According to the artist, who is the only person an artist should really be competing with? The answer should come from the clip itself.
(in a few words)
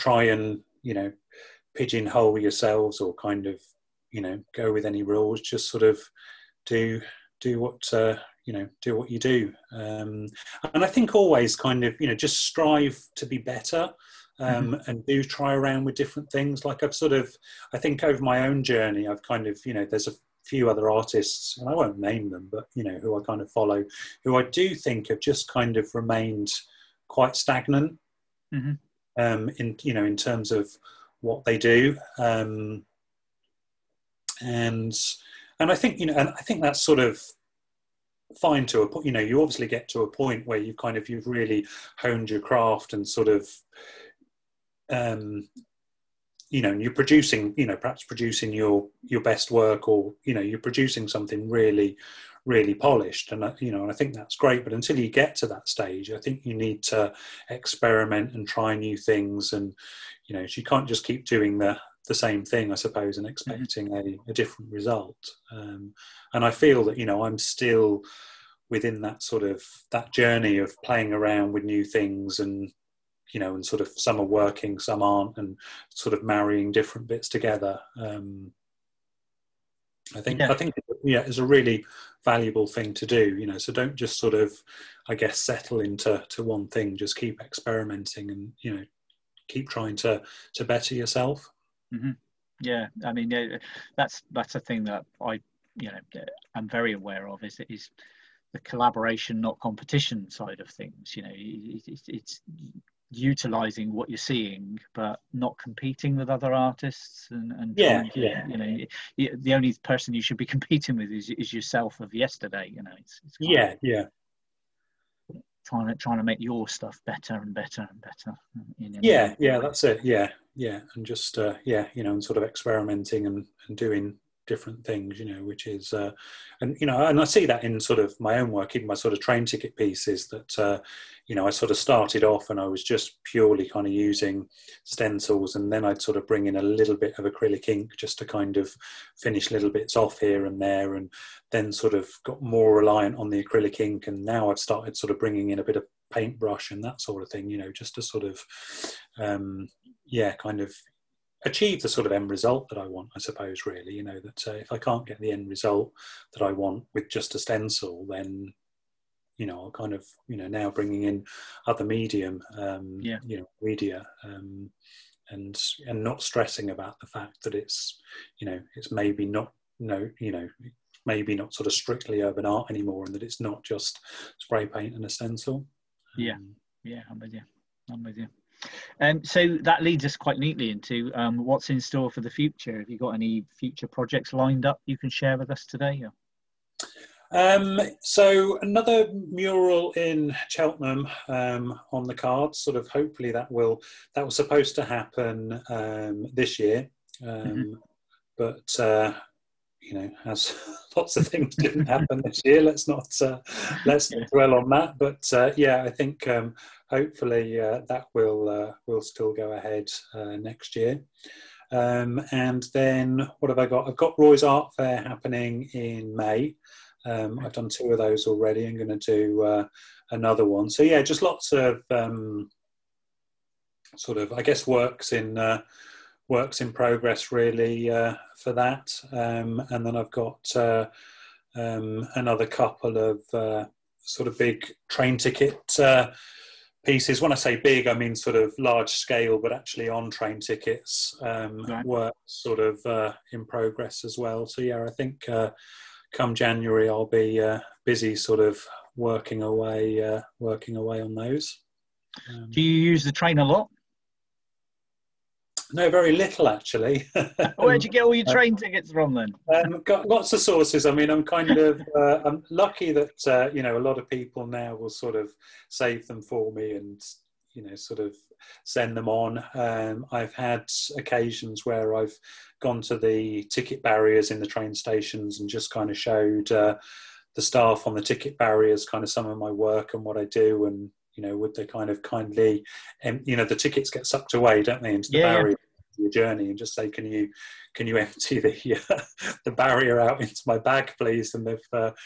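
Yourself of yesterday.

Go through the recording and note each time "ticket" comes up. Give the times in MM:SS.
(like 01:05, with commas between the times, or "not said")
02:09, 03:55, 04:00, 04:18, 04:33, 04:38, 04:43.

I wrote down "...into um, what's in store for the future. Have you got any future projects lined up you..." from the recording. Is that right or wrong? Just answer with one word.
right.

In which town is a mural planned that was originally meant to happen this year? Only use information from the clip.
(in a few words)
Cheltenham.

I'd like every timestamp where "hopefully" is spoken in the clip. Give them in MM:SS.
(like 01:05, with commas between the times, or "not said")
03:12, 03:26.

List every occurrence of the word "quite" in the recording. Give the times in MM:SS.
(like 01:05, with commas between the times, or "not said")
00:27, 03:00.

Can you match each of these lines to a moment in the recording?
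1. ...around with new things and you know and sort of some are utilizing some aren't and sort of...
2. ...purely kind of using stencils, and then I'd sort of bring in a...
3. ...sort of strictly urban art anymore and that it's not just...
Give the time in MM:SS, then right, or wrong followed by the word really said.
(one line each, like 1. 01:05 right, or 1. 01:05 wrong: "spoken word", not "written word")
1. 01:11 wrong: "working", not "utilizing"
2. 02:13 right
3. 02:51 right.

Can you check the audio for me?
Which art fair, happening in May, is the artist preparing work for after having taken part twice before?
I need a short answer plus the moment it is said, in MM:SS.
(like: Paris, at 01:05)
Roy's Art Fair, at 03:34.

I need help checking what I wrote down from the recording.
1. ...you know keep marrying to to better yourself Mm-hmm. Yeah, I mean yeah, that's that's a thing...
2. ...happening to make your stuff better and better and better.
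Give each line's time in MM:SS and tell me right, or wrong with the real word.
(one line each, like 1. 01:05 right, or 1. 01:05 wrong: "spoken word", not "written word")
1. 01:28 wrong: "trying", not "marrying"
2. 01:55 wrong: "trying", not "happening".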